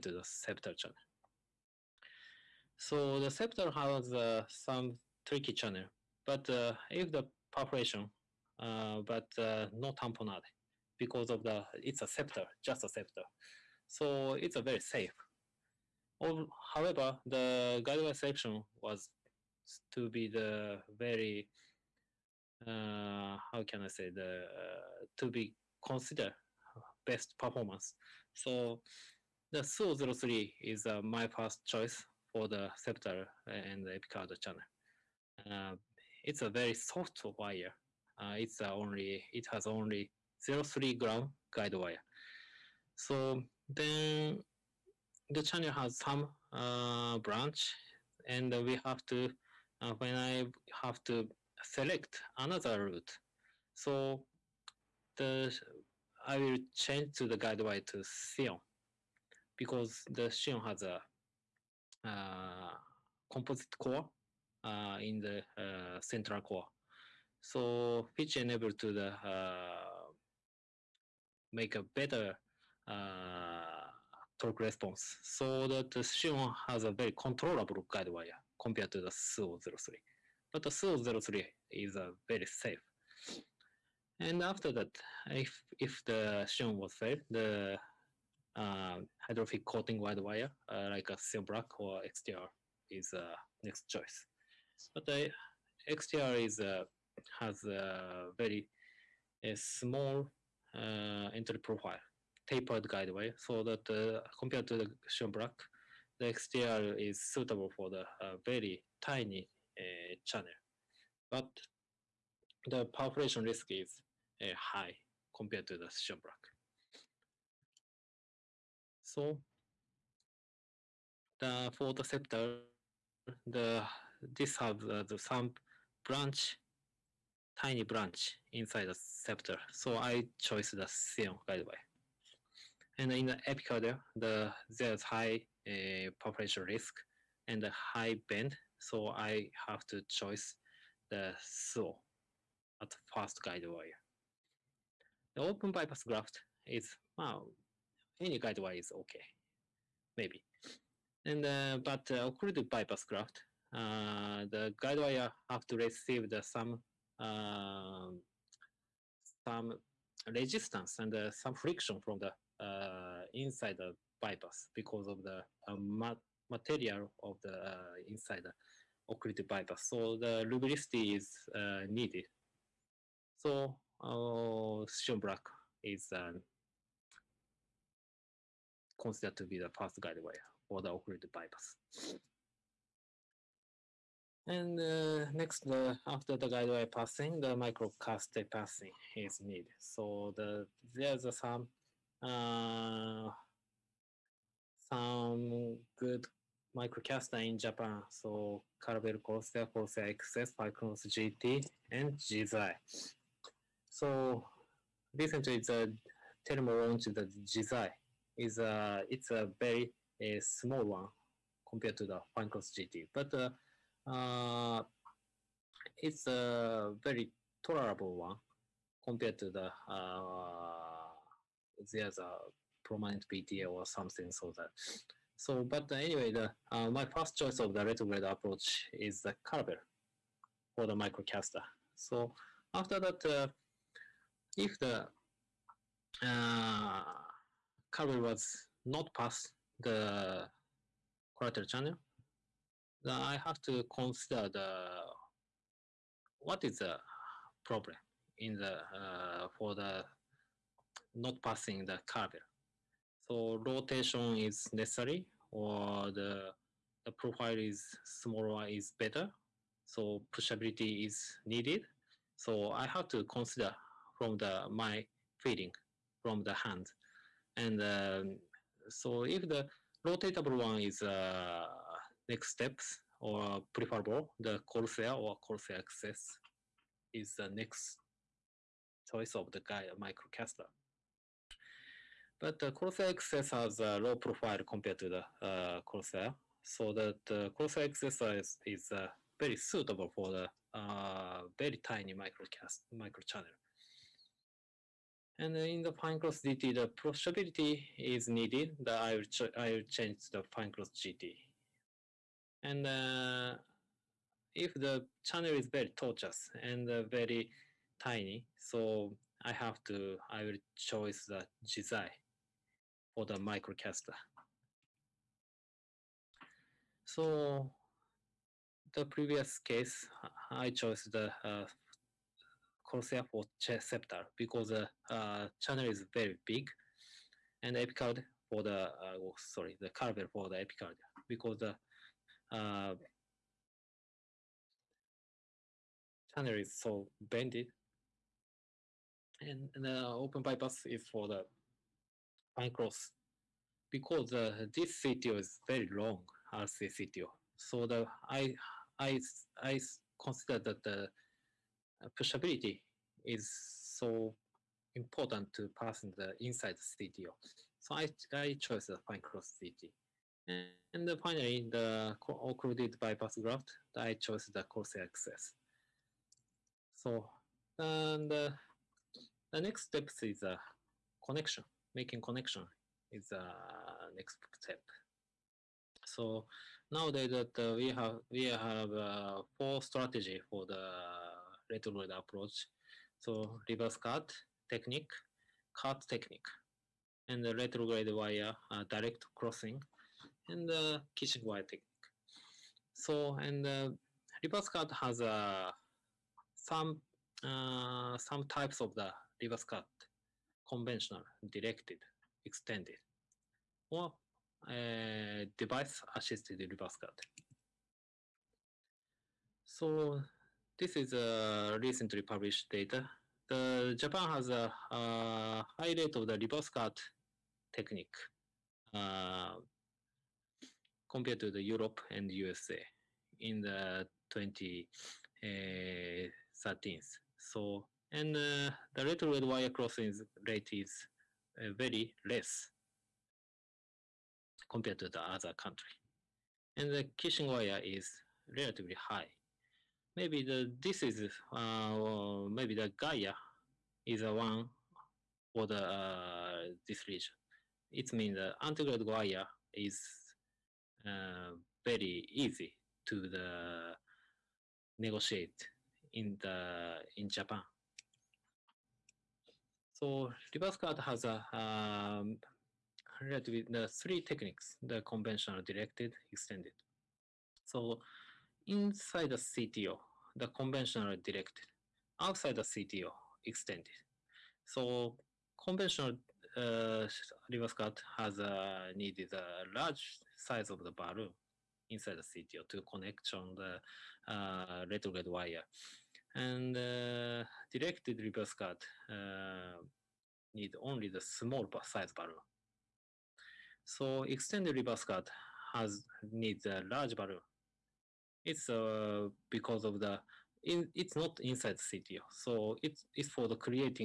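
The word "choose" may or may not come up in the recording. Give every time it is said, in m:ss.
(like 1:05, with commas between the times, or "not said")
2:20, 5:10.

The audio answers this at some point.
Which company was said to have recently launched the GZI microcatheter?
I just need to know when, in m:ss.
3:26.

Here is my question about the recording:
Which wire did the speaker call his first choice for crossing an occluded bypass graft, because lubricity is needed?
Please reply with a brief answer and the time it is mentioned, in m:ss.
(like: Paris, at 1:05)
Sion Black, at 2:54.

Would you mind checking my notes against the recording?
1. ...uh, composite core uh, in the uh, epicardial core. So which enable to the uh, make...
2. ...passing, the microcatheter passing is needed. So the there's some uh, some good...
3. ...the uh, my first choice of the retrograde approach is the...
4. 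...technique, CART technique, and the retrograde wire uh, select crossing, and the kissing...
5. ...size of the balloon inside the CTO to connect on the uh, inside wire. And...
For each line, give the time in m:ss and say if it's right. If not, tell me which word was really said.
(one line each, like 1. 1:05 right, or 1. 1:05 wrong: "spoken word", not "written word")
1. 1:02 wrong: "central", not "epicardial"
2. 3:06 right
3. 3:46 right
4. 6:24 wrong: "direct", not "select"
5. 8:00 wrong: "retrograde", not "inside".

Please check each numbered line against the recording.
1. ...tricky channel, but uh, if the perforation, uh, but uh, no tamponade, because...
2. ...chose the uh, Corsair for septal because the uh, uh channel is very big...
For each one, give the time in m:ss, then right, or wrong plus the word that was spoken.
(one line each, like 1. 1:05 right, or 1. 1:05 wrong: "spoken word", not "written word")
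1. 0:05 right
2. 5:20 right.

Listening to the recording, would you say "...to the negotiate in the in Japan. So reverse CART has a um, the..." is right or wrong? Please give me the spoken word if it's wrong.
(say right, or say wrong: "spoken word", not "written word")
right.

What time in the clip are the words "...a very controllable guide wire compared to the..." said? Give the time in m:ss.
1:16.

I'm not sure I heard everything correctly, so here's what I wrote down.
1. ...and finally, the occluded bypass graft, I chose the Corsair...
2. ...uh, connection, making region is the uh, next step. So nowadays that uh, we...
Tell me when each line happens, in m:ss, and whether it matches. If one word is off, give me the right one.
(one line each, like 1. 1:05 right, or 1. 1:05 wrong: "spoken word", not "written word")
1. 6:01 right
2. 6:10 wrong: "connection", not "region".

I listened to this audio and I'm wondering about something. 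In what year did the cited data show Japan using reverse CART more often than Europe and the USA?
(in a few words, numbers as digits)
2013.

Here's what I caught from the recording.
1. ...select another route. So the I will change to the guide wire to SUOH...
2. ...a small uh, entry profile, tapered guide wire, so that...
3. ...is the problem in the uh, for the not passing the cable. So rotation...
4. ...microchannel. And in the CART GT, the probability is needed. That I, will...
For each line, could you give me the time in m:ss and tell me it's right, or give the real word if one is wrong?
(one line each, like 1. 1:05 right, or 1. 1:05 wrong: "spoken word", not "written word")
1. 0:51 wrong: "Sion", not "SUOH"
2. 1:39 right
3. 4:06 right
4. 4:52 wrong: "Finecross", not "CART".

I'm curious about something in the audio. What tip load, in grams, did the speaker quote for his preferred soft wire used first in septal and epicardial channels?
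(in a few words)
0.3 gram.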